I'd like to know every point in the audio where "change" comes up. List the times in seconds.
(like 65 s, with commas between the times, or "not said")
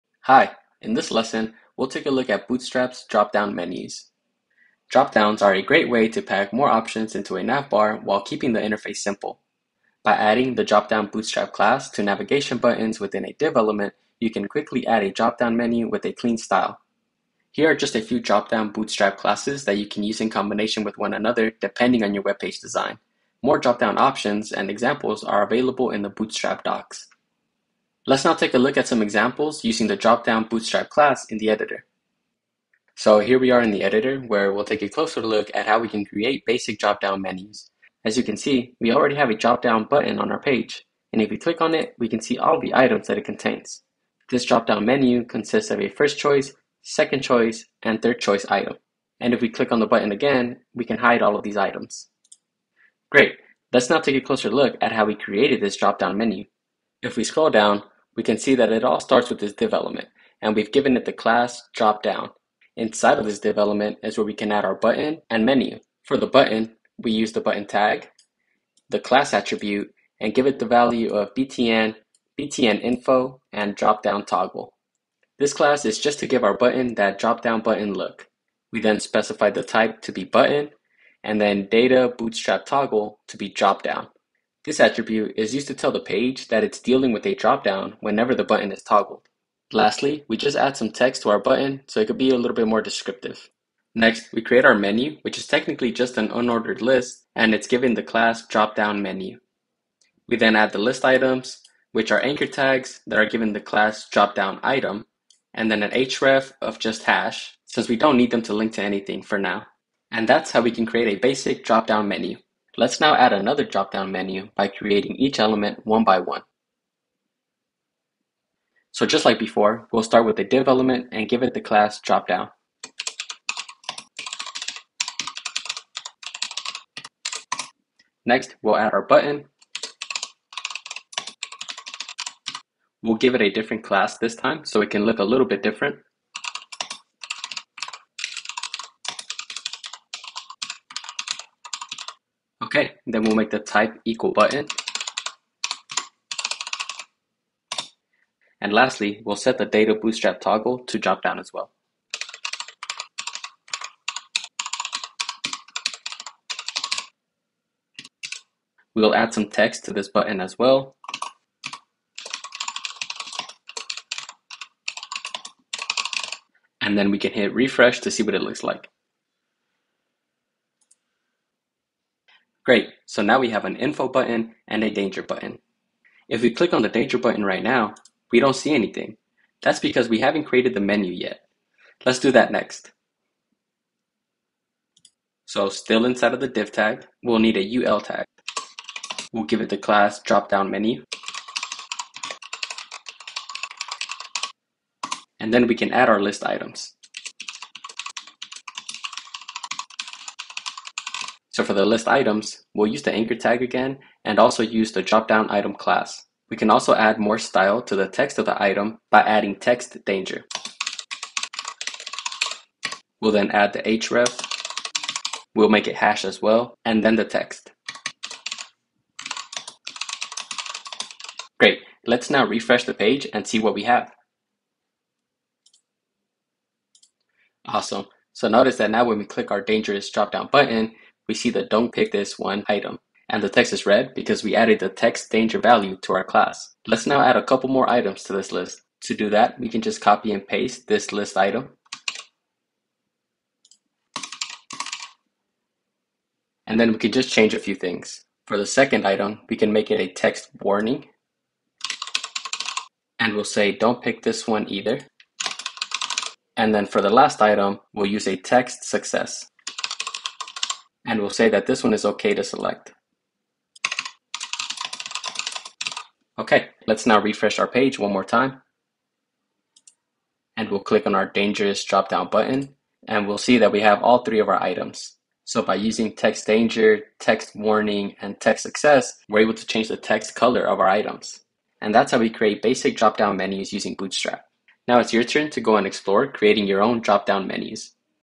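247 s, 279 s.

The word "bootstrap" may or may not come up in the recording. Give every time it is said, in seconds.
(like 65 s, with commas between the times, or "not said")
2 s, 11 s, 18 s, 26 s, 30 s, 82 s, 149 s, 283 s.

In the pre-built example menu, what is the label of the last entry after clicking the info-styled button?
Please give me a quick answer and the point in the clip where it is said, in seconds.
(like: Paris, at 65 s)
third choice, at 48 s.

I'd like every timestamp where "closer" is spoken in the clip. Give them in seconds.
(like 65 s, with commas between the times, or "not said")
34 s, 54 s.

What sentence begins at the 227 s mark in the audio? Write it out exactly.
Awesome, so notice that now when we click our dangerous drop down button, we see the don't pick this one item.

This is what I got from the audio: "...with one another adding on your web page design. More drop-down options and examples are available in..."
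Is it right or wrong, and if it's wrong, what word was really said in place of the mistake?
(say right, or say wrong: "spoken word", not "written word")
wrong: "depending", not "adding".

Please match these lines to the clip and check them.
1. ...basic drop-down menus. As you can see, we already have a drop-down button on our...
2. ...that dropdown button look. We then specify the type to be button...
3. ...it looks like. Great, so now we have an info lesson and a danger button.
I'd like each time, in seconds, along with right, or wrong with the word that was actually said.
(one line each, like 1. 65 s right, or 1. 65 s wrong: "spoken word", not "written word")
1. 36 s right
2. 76 s right
3. 168 s wrong: "button", not "lesson".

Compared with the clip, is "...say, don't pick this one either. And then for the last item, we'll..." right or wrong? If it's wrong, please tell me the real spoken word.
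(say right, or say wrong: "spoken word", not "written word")
right.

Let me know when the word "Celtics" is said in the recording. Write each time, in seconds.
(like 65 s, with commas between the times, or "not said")
not said.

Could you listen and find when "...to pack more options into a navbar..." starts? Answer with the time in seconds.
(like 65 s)
6 s.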